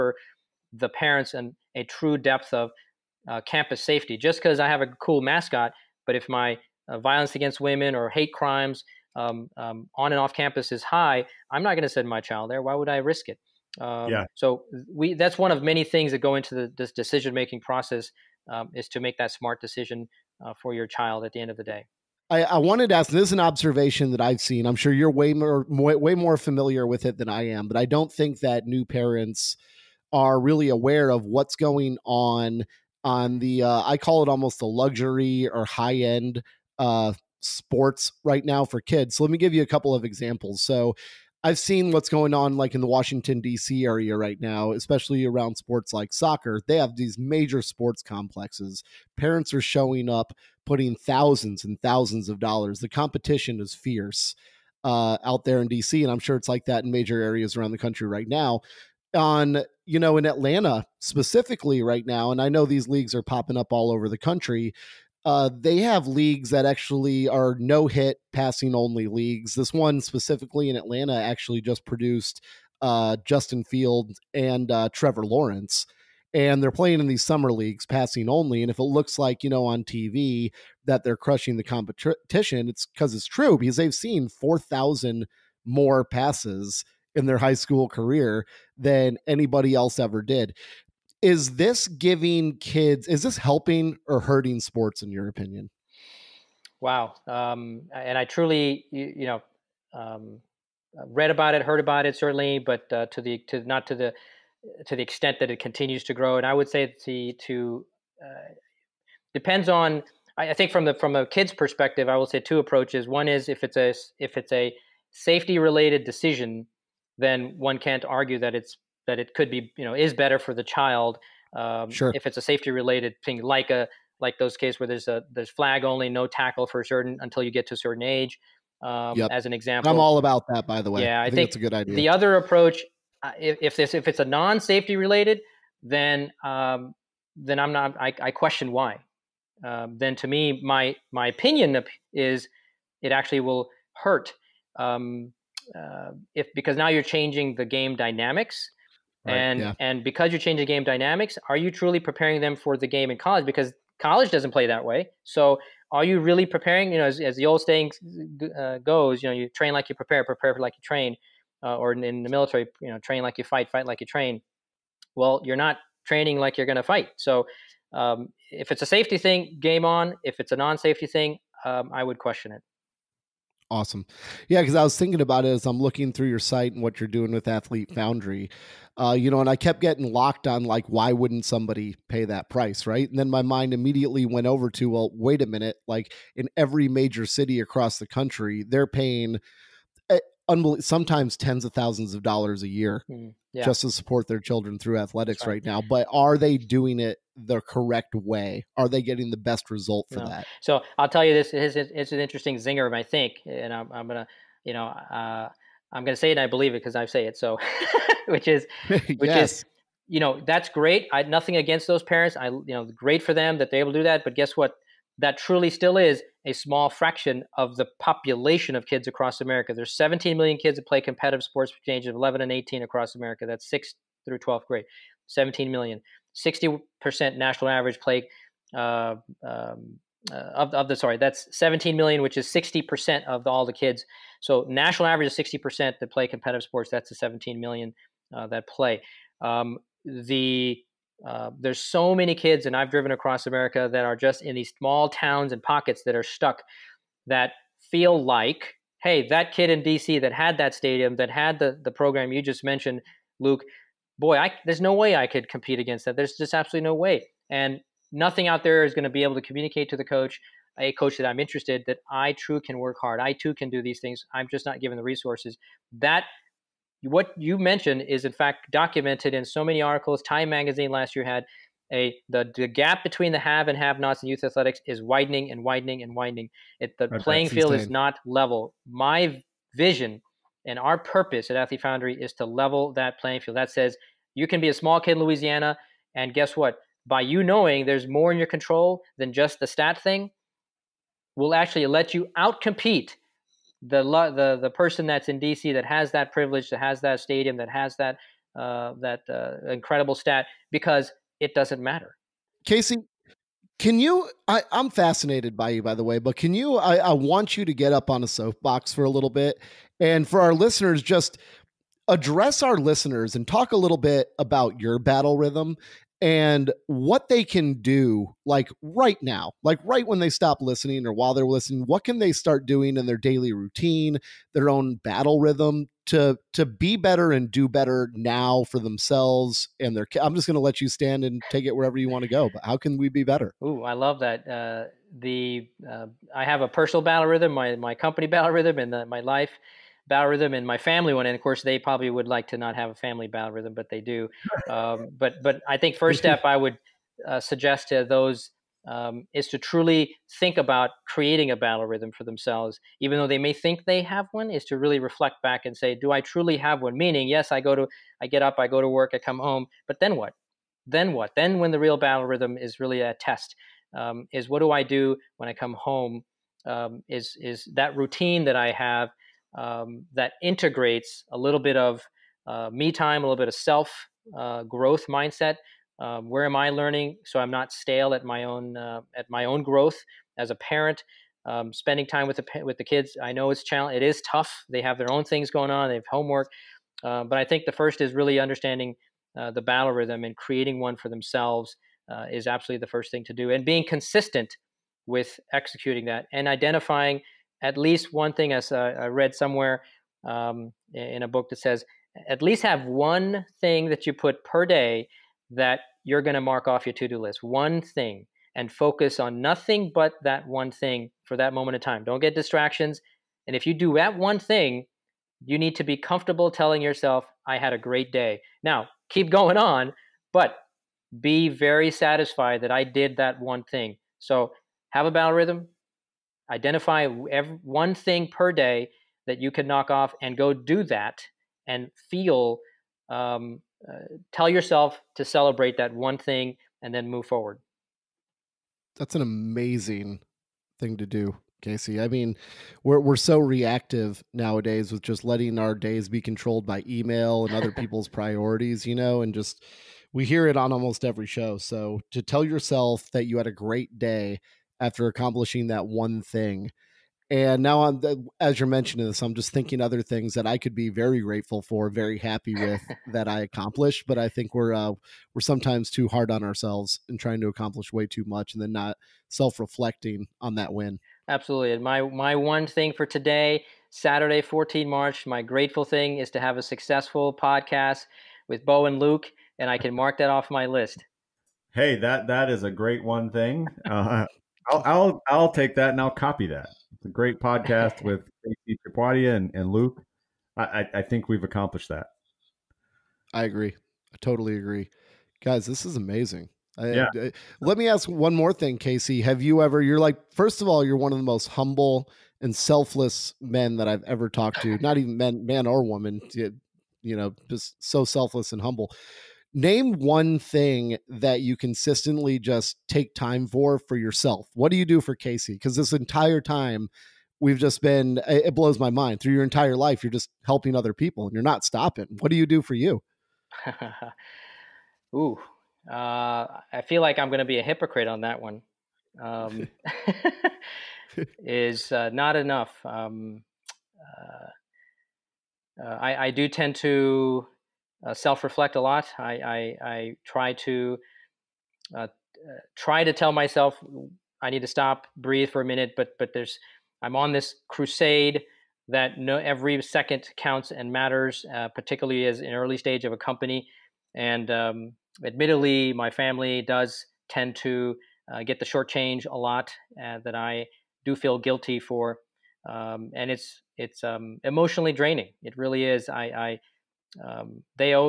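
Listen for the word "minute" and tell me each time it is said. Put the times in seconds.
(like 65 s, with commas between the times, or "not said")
185 s, 545 s.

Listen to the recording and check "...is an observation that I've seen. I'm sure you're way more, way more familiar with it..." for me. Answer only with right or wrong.
right.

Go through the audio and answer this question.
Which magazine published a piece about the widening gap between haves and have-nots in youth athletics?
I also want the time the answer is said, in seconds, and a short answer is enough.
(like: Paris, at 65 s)
Time magazine, at 270 s.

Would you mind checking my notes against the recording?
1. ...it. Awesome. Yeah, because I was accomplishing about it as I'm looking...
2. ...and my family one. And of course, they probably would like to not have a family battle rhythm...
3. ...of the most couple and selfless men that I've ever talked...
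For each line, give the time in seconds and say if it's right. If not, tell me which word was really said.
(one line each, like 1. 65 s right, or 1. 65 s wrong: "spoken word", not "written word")
1. 172 s wrong: "thinking", not "accomplishing"
2. 340 s right
3. 501 s wrong: "humble", not "couple".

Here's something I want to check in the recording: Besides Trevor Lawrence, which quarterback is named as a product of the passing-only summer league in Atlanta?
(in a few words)
Justin Fields.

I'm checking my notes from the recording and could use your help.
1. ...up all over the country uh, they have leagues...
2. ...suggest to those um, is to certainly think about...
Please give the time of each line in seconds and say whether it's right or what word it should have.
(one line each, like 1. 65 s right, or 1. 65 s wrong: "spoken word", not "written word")
1. 63 s right
2. 347 s wrong: "truly", not "certainly".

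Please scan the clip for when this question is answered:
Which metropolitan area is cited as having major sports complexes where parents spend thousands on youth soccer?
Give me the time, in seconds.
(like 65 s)
42 s.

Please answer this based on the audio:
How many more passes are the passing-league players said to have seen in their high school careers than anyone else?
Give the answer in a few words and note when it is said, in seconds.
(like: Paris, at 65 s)
4,000, at 84 s.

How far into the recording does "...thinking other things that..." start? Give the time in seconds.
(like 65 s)
459 s.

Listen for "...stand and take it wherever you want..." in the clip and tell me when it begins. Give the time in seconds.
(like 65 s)
330 s.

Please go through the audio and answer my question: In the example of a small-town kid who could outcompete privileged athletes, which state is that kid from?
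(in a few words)
Louisiana.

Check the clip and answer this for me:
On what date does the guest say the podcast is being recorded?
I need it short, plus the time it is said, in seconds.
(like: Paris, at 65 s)
Saturday, 14 March, at 473 s.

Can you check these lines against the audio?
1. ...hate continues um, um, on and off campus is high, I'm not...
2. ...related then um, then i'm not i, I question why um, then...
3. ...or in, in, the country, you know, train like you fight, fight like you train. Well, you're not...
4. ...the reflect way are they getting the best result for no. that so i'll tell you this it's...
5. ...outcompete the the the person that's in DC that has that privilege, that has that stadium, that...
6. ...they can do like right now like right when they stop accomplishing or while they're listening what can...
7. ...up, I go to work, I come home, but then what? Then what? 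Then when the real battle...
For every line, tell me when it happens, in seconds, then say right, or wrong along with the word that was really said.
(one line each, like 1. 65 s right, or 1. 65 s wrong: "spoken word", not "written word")
1. 8 s wrong: "crimes", not "continues"
2. 134 s right
3. 161 s wrong: "military", not "country"
4. 197 s wrong: "correct", not "reflect"
5. 292 s right
6. 317 s wrong: "listening", not "accomplishing"
7. 358 s right.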